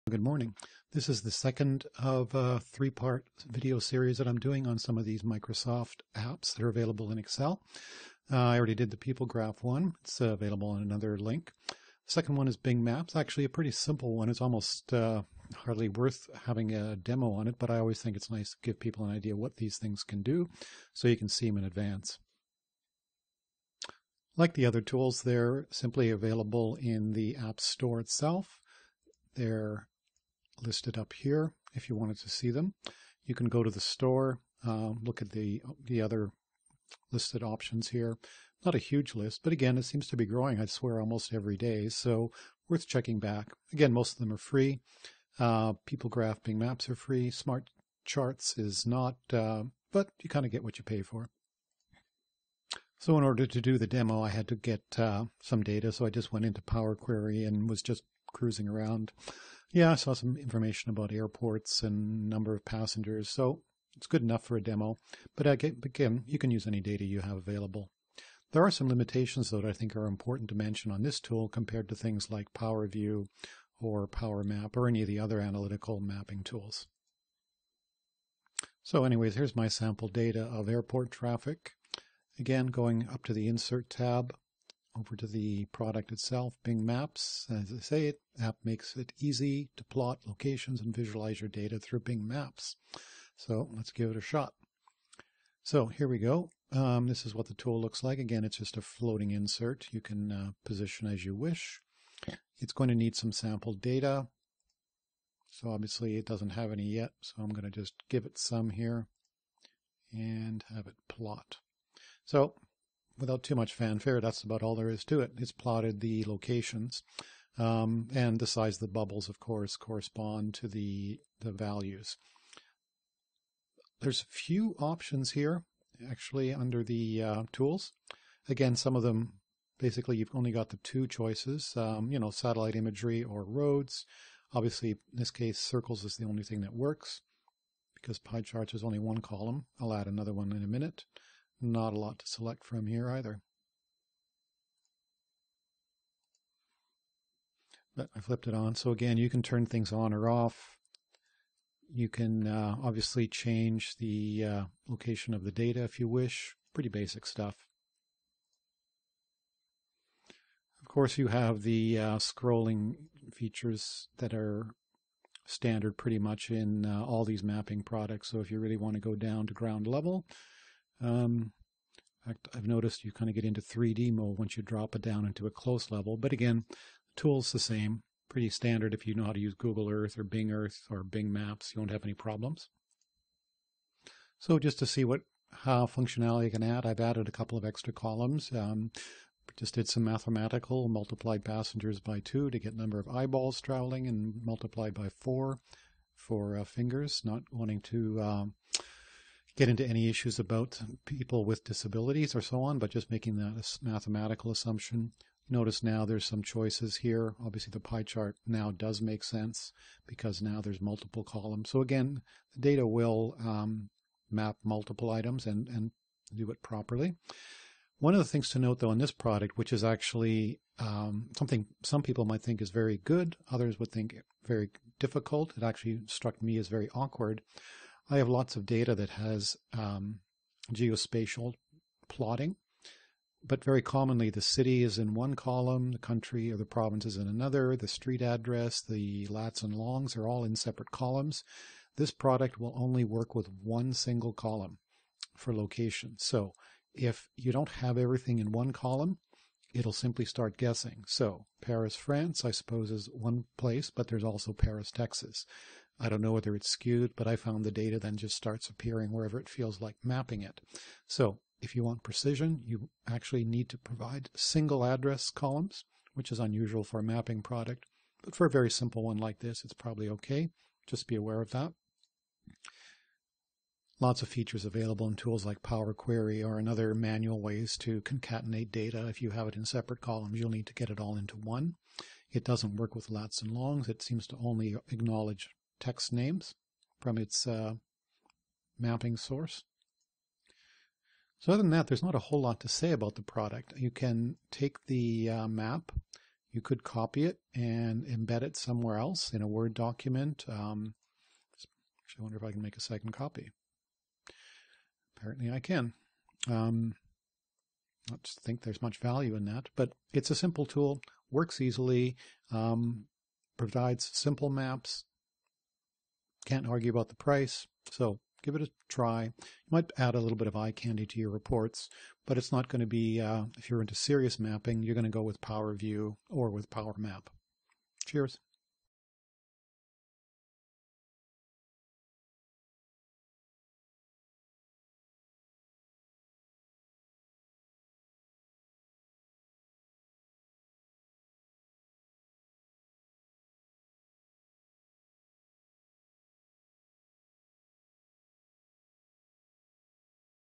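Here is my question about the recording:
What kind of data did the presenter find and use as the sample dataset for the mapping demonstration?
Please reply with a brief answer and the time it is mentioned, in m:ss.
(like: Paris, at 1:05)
Airport traffic, at 1:20.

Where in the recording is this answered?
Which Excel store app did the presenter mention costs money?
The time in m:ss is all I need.
0:47.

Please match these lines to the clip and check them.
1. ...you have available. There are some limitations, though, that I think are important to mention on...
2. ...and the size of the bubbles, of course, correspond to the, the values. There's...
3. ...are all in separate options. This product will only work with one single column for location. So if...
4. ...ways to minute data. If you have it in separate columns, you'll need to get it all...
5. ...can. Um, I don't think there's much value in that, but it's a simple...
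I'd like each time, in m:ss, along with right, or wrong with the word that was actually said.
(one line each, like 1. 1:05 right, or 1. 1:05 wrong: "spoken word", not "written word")
1. 1:07 right
2. 1:58 right
3. 4:00 wrong: "columns", not "options"
4. 4:37 wrong: "concatenate", not "minute"
5. 5:05 right.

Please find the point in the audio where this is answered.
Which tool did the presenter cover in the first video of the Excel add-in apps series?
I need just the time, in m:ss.
0:08.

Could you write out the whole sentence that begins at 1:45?
So obviously it doesn't have any yet, so I'm going to just give it some here and have it plot.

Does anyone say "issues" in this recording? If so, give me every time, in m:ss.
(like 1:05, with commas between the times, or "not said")
3:20.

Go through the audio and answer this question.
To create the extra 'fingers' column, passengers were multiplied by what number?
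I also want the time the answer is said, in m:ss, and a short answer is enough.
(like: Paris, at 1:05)
4, at 3:15.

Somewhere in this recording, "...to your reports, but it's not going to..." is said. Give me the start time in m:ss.
5:21.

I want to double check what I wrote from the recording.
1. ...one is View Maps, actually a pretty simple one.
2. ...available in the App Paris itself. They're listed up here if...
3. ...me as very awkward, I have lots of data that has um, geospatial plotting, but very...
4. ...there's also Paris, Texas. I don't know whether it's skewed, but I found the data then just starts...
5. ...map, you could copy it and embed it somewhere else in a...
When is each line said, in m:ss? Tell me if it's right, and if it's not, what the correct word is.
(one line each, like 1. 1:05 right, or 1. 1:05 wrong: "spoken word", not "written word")
1. 0:12 wrong: "Bing", not "View"
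2. 0:26 wrong: "Store", not "Paris"
3. 3:46 right
4. 4:14 right
5. 4:55 right.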